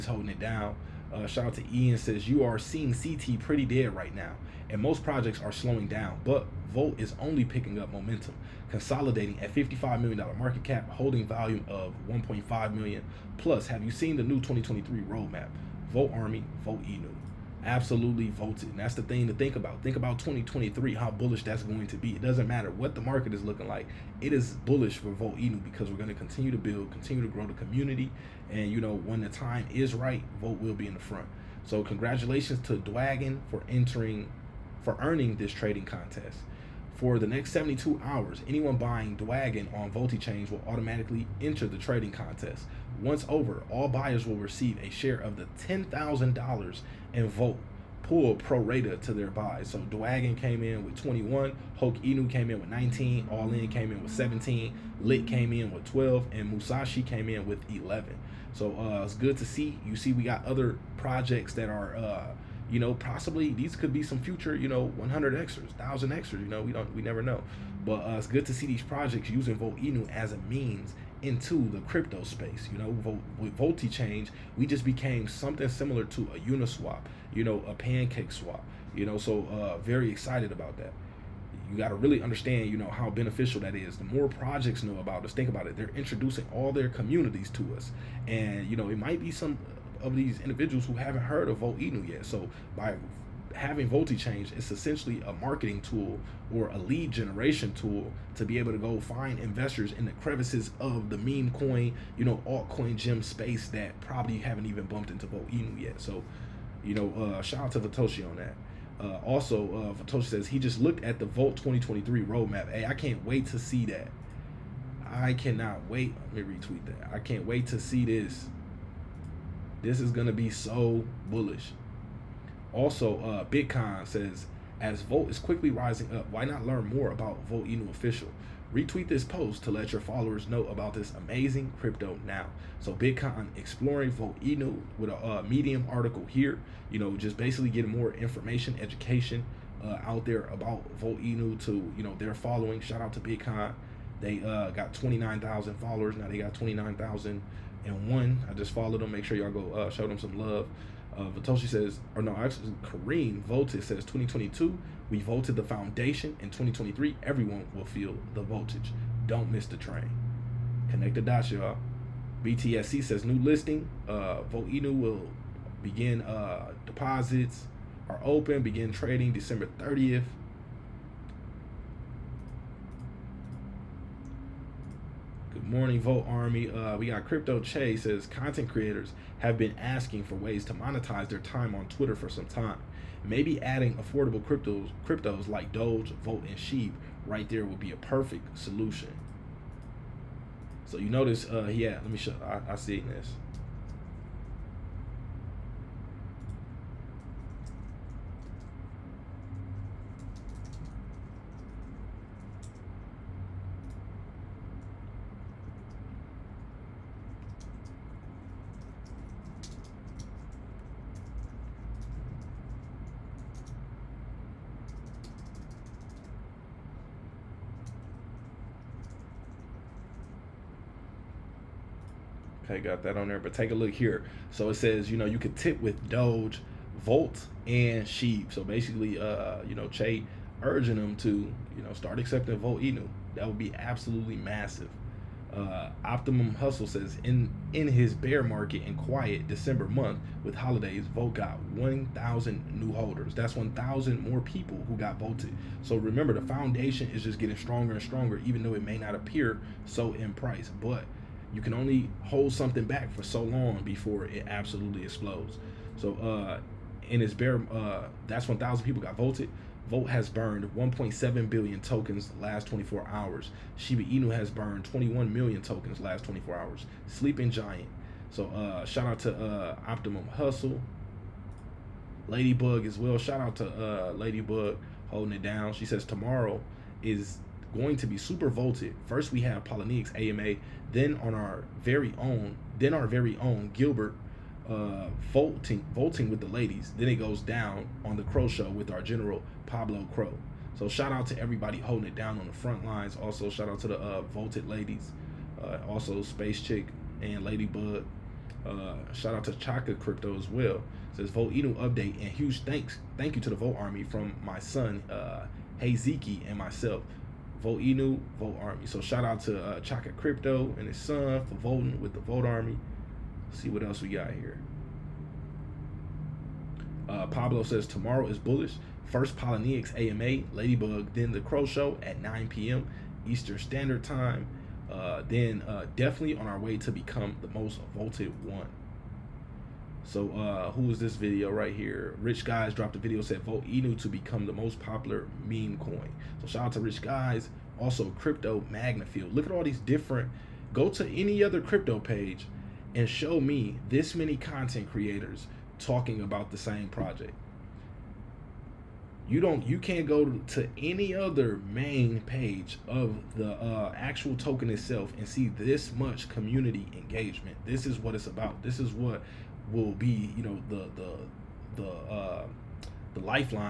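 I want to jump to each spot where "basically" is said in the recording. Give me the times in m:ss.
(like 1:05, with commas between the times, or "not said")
2:17, 3:48.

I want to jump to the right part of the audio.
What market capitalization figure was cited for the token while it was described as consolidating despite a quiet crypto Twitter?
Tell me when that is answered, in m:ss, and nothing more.
0:09.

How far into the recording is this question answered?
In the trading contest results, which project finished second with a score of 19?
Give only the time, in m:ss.
0:51.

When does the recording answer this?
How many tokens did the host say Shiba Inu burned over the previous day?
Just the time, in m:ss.
4:24.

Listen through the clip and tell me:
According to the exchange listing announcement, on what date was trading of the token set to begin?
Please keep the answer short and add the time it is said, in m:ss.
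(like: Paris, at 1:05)
December 30th, at 2:49.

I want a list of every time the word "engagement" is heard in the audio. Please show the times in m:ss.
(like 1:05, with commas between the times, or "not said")
5:56.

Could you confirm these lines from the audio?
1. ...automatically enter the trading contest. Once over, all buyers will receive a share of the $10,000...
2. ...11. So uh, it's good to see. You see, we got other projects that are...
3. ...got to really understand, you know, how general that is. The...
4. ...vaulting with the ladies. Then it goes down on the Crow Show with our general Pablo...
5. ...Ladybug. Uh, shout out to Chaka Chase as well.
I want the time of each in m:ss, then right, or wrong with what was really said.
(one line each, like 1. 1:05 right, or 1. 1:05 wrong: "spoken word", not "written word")
1. 0:40 right
2. 0:57 right
3. 1:21 wrong: "beneficial", not "general"
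4. 4:45 right
5. 4:57 wrong: "Crypto", not "Chase".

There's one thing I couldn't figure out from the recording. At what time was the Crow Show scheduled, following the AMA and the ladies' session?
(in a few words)
9 p.m. Eastern.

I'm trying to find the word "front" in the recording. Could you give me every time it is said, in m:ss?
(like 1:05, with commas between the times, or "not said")
0:30, 4:52.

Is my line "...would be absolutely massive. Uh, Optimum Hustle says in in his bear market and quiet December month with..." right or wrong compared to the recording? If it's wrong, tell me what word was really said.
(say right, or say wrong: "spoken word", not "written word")
right.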